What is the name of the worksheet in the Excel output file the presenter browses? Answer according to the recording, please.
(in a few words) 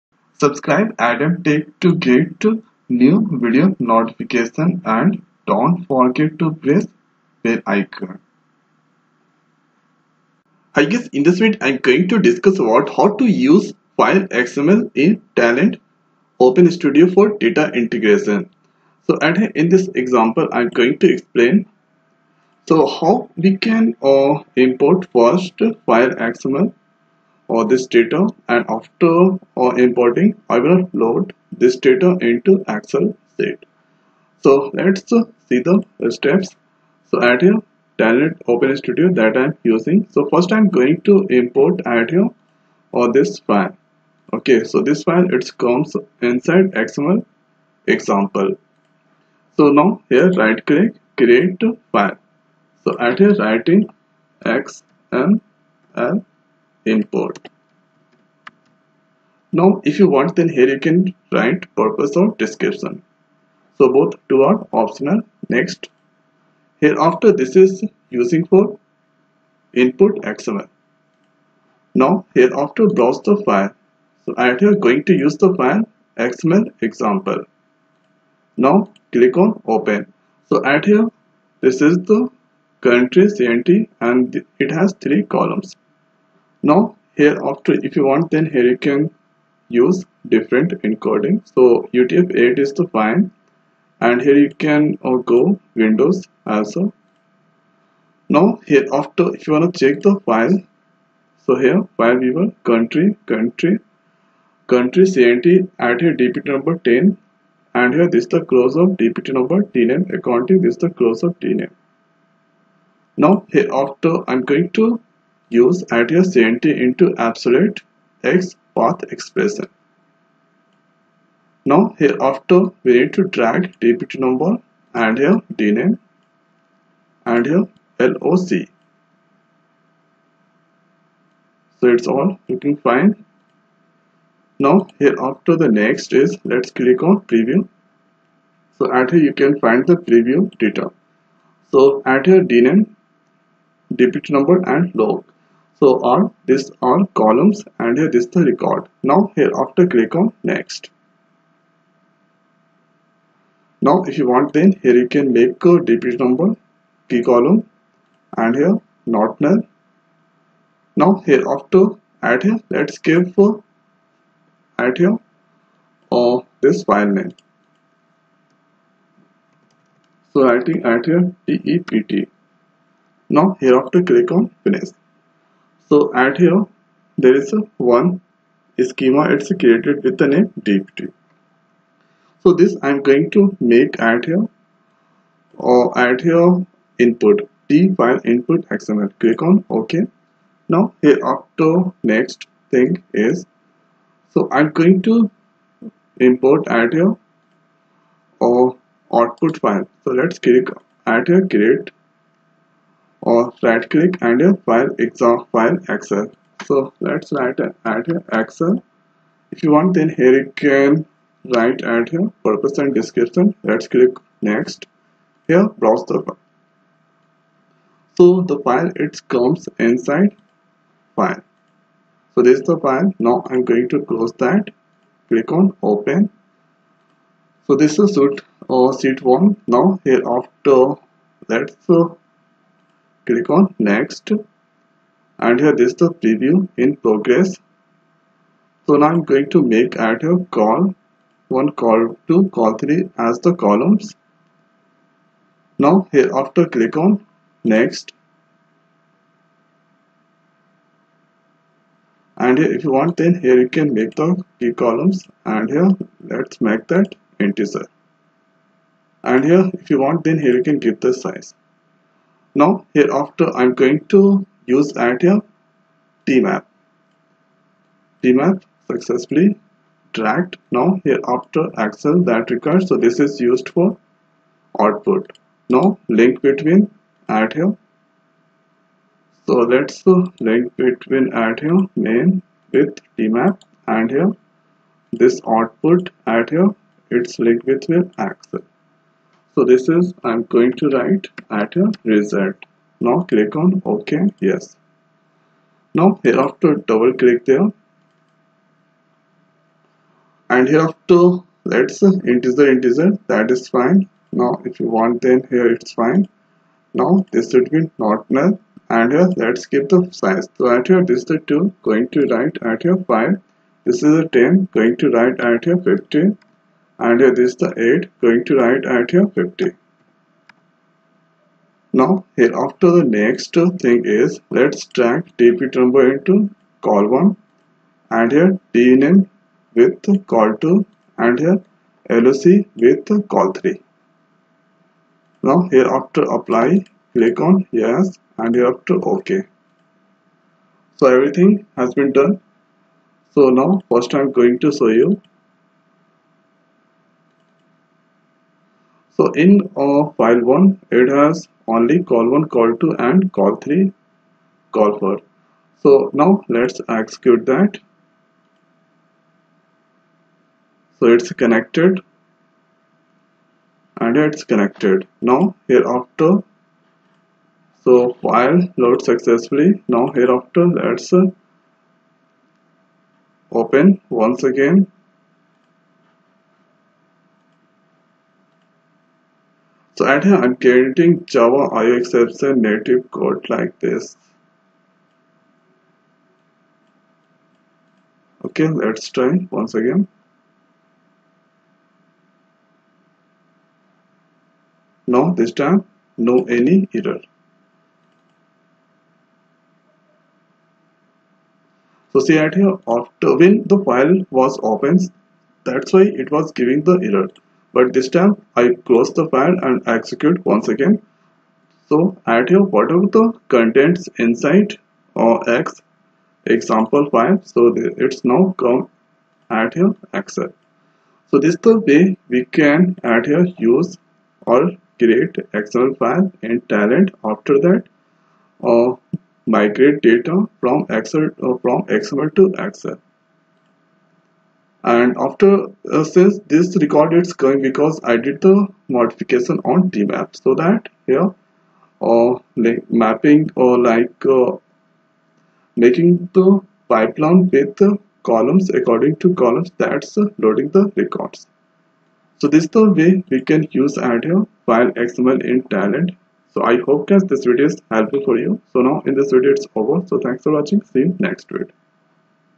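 sheet one.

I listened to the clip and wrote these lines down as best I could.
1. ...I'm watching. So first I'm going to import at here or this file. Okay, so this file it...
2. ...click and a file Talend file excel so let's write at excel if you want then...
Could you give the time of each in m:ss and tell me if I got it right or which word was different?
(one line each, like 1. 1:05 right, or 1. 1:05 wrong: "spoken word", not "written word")
1. 0:39 wrong: "using", not "watching"
2. 3:23 wrong: "Excel", not "Talend".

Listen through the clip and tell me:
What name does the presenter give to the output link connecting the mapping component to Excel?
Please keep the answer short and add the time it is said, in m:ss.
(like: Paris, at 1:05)
result, at 4:52.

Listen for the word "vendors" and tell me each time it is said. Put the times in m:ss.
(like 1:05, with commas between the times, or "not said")
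not said.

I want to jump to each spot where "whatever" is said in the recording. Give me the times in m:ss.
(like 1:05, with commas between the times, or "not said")
6:52.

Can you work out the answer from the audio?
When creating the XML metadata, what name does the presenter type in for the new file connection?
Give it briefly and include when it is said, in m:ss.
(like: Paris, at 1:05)
XML import, at 0:54.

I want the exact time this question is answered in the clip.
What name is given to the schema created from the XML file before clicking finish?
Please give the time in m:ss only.
2:51.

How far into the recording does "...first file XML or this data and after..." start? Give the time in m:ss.
0:25.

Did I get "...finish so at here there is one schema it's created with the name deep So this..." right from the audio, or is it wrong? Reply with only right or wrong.
right.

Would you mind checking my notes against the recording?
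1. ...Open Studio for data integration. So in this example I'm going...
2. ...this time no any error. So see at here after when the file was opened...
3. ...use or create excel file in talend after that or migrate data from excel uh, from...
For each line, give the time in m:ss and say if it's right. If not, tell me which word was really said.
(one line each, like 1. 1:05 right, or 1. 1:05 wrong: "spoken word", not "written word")
1. 0:16 right
2. 6:35 right
3. 7:03 right.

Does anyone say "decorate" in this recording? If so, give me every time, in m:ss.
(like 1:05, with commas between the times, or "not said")
not said.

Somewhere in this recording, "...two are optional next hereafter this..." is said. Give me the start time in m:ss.
1:04.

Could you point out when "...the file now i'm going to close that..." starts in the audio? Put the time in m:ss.
3:42.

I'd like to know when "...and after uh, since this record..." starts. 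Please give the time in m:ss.
7:14.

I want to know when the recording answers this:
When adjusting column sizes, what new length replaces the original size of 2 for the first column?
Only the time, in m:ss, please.
5:13.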